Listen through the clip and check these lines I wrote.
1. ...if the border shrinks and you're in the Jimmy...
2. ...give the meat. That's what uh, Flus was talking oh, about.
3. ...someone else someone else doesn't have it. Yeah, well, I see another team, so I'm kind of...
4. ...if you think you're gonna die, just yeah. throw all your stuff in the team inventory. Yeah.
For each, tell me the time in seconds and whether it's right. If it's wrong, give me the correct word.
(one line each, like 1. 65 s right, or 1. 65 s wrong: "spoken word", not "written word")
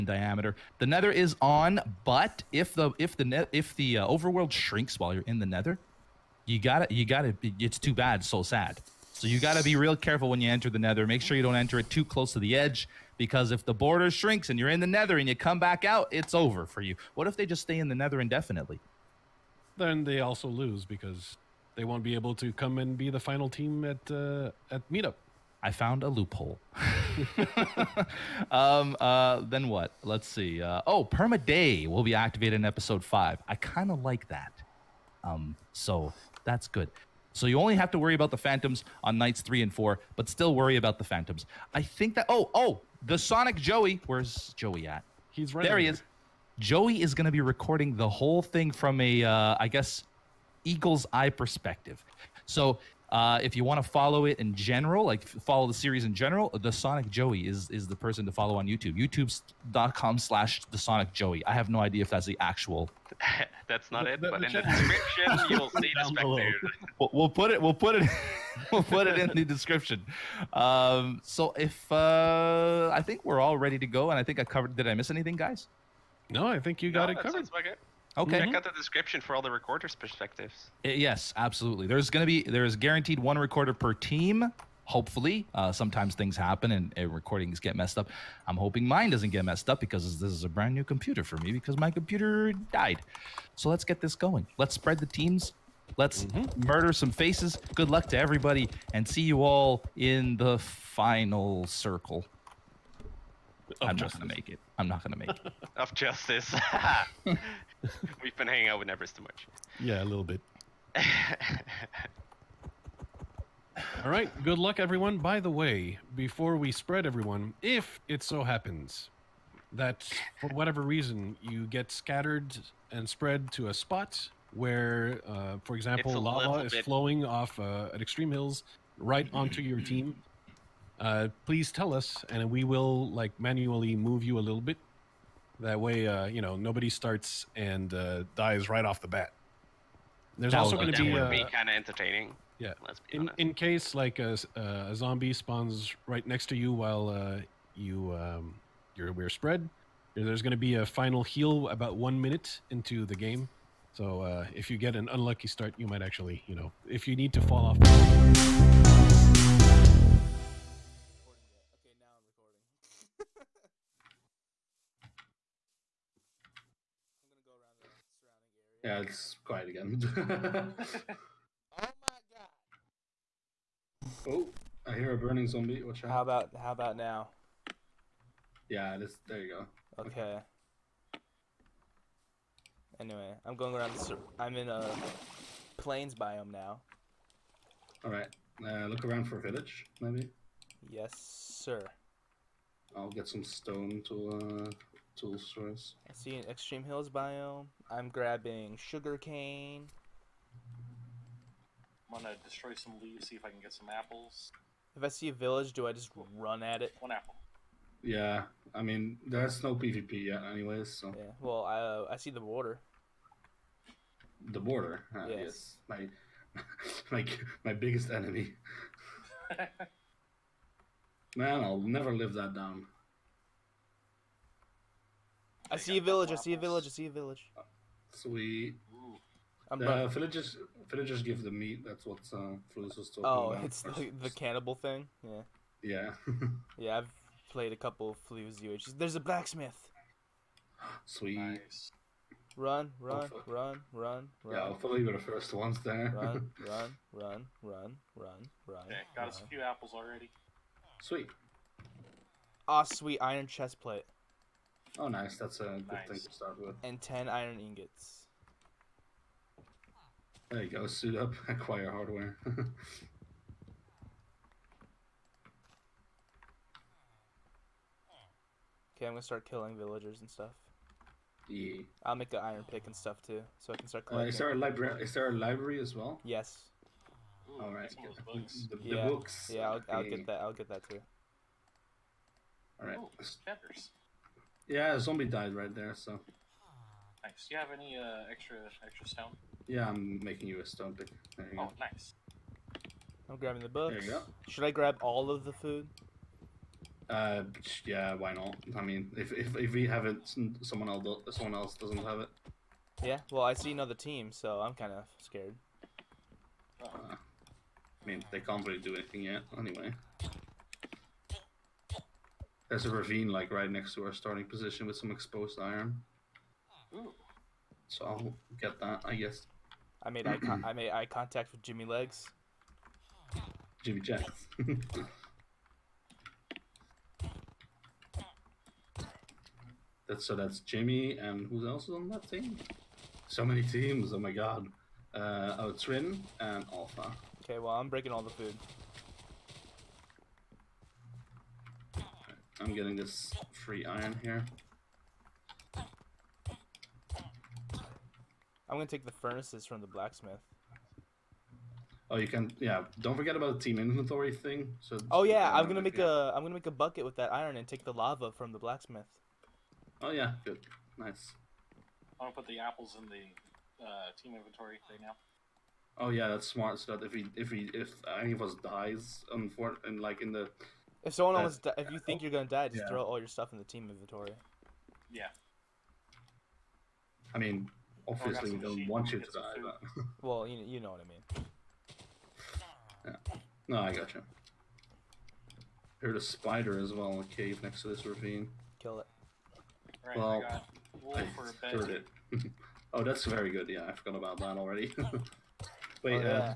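1. 13 s wrong: "Nether", not "Jimmy"
2. 231 s right
3. 300 s right
4. 371 s right.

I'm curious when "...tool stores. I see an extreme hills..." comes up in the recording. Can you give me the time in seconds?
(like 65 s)
195 s.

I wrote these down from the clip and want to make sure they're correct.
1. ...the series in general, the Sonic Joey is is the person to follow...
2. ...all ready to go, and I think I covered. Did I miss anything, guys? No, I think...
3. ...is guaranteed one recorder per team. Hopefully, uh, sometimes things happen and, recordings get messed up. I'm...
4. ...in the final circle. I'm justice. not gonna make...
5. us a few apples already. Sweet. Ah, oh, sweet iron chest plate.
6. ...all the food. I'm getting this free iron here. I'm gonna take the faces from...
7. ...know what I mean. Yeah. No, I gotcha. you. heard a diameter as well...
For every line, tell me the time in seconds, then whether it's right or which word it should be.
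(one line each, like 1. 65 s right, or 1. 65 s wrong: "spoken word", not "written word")
1. 55 s right
2. 73 s right
3. 82 s right
4. 99 s right
5. 249 s right
6. 338 s wrong: "furnaces", not "faces"
7. 380 s wrong: "spider", not "diameter".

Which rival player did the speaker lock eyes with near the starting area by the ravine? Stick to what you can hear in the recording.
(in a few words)
Jimmy Legs.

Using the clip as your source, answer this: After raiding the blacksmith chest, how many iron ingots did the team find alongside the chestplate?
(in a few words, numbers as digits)
10.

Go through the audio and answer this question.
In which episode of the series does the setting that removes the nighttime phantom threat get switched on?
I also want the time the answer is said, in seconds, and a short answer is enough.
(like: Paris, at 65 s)
5, at 32 s.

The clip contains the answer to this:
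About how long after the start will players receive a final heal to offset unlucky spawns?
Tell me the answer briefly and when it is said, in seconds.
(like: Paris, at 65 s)
One minute, at 151 s.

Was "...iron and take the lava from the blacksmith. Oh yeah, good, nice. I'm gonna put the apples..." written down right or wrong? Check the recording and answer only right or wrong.
right.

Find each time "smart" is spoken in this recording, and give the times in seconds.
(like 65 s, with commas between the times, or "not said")
366 s.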